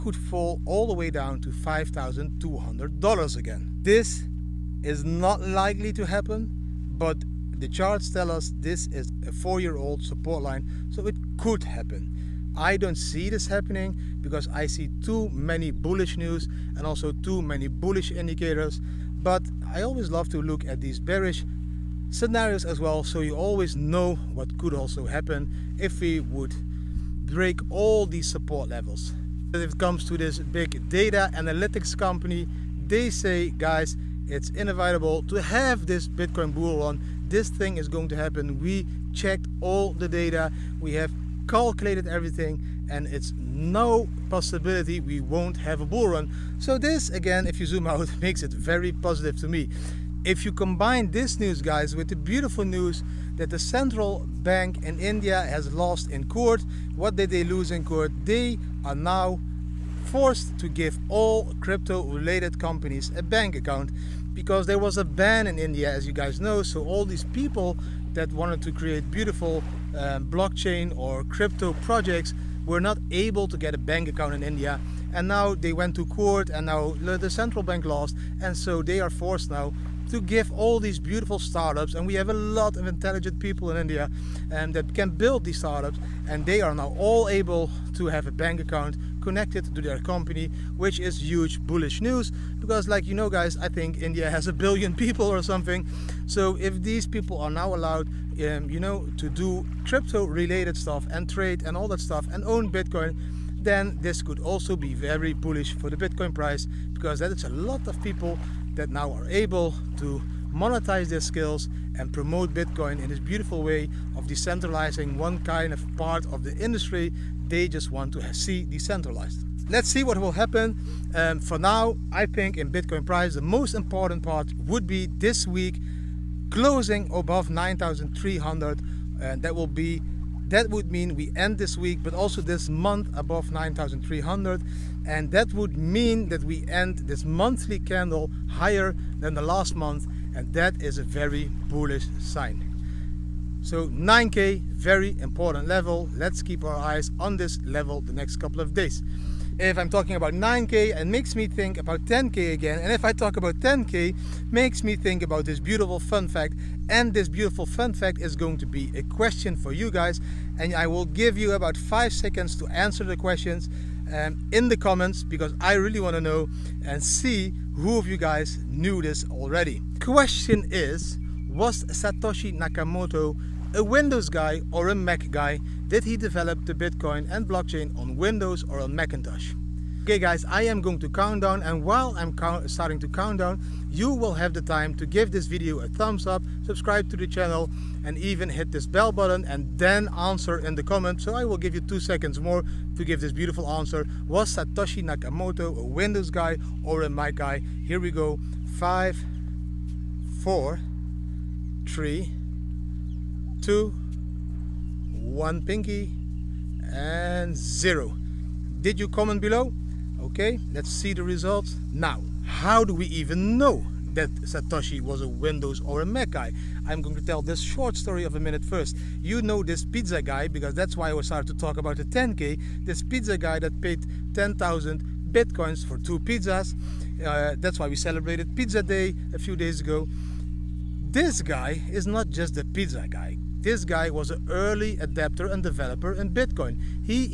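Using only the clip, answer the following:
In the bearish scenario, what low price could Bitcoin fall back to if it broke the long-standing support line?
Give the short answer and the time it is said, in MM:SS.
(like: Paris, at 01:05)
$5,200, at 00:01.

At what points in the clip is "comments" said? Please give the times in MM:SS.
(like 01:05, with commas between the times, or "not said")
02:44, 03:10, 03:29.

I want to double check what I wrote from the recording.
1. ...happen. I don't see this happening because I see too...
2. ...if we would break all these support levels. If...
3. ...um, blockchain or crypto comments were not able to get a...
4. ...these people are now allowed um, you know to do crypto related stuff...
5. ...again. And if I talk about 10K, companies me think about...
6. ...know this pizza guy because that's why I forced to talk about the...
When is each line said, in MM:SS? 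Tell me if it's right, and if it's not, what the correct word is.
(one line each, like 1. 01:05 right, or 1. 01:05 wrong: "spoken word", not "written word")
1. 00:11 right
2. 00:25 right
3. 01:09 wrong: "projects", not "comments"
4. 01:36 right
5. 02:32 wrong: "makes", not "companies"
6. 03:39 wrong: "started", not "forced".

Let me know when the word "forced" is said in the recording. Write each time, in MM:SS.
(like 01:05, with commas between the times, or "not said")
01:00, 01:19.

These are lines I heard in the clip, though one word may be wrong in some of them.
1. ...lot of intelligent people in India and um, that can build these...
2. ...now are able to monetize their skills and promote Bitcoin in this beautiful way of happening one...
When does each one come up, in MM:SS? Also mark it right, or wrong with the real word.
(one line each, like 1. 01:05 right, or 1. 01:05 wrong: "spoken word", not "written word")
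1. 01:22 right
2. 01:48 wrong: "decentralizing", not "happening".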